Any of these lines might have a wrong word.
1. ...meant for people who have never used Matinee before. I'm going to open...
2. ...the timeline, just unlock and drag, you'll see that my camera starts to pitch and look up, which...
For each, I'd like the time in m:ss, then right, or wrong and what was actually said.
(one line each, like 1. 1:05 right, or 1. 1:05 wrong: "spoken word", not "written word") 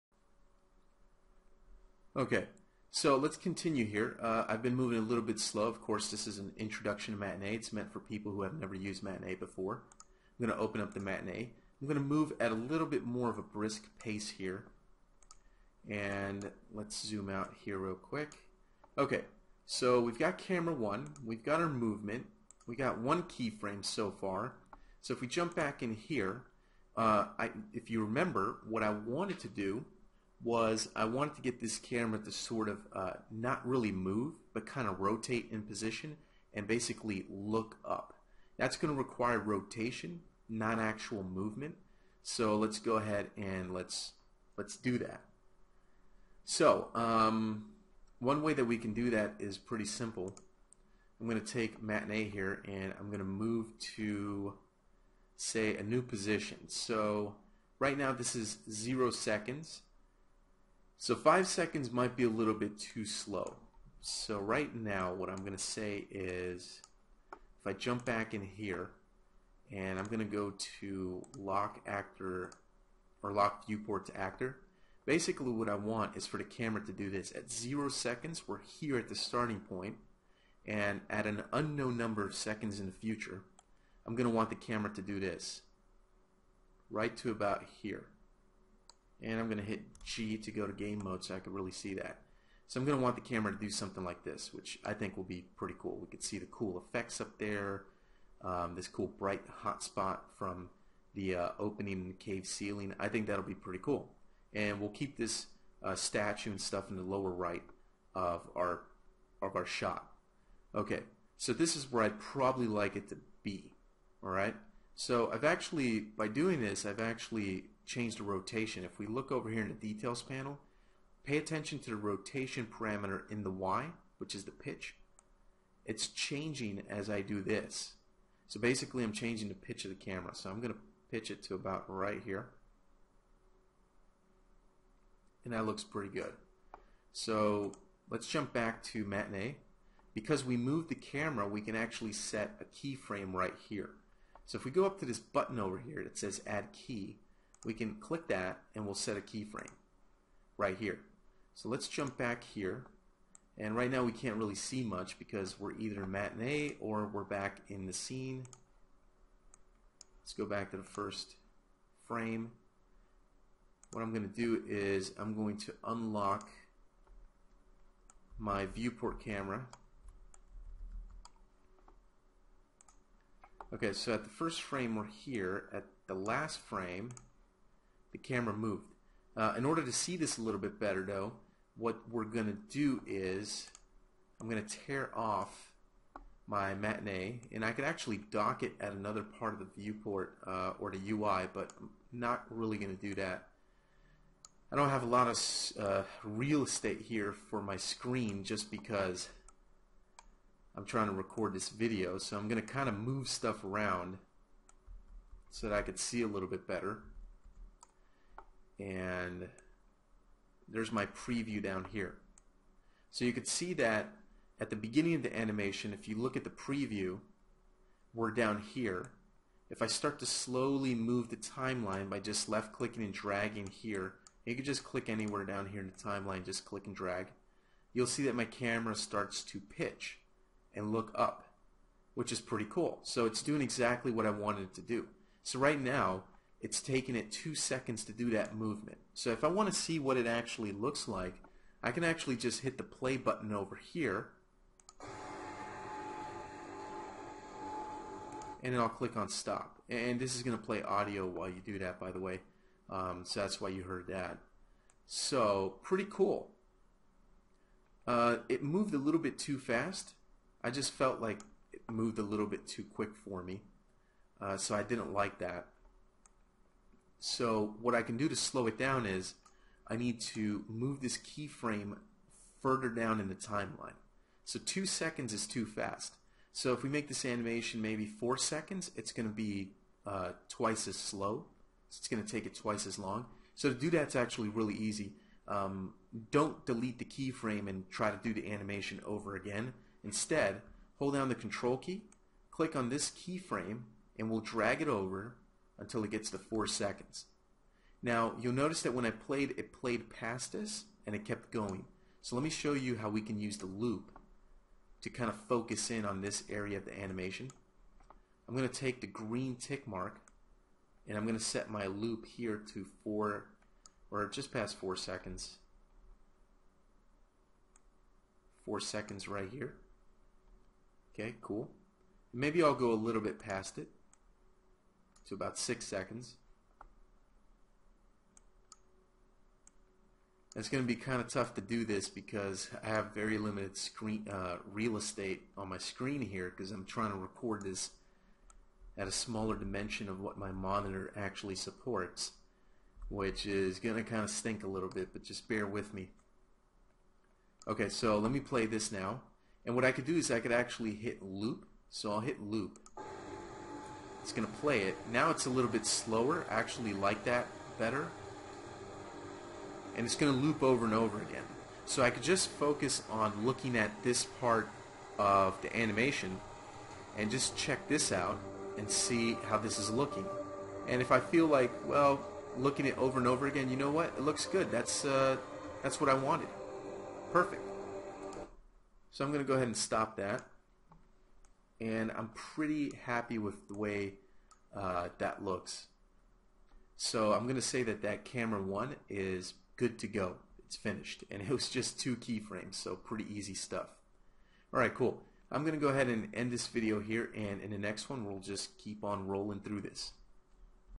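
1. 0:07 right
2. 3:45 wrong: "click", not "unlock".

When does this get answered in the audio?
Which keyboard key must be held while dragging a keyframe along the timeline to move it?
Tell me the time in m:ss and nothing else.
4:51.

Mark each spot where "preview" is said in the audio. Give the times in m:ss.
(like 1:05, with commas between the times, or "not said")
3:31, 3:36.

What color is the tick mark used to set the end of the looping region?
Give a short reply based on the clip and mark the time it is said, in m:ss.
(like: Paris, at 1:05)
green, at 5:09.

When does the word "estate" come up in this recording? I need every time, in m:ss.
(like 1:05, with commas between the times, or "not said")
3:16, 5:34.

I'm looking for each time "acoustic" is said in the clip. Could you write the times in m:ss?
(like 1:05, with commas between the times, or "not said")
not said.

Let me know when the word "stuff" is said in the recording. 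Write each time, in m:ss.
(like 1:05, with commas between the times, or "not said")
1:46, 3:23, 6:33.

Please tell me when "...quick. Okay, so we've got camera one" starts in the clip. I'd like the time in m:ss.
0:17.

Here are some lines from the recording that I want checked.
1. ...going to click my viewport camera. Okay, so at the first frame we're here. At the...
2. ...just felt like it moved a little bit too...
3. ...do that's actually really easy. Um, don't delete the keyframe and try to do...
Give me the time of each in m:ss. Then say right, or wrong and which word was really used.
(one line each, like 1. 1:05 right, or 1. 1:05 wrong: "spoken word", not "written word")
1. 2:45 wrong: "unlock", not "click"
2. 4:20 right
3. 4:43 right.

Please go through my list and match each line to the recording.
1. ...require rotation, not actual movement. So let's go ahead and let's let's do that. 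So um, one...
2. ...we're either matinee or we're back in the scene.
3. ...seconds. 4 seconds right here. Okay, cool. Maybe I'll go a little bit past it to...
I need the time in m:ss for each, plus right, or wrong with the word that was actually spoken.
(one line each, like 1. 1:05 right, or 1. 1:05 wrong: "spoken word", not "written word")
1. 0:38 right
2. 2:35 right
3. 5:14 right.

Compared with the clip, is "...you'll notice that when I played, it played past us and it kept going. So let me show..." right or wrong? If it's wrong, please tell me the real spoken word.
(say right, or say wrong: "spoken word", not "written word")
right.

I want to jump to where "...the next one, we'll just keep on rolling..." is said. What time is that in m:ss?
6:37.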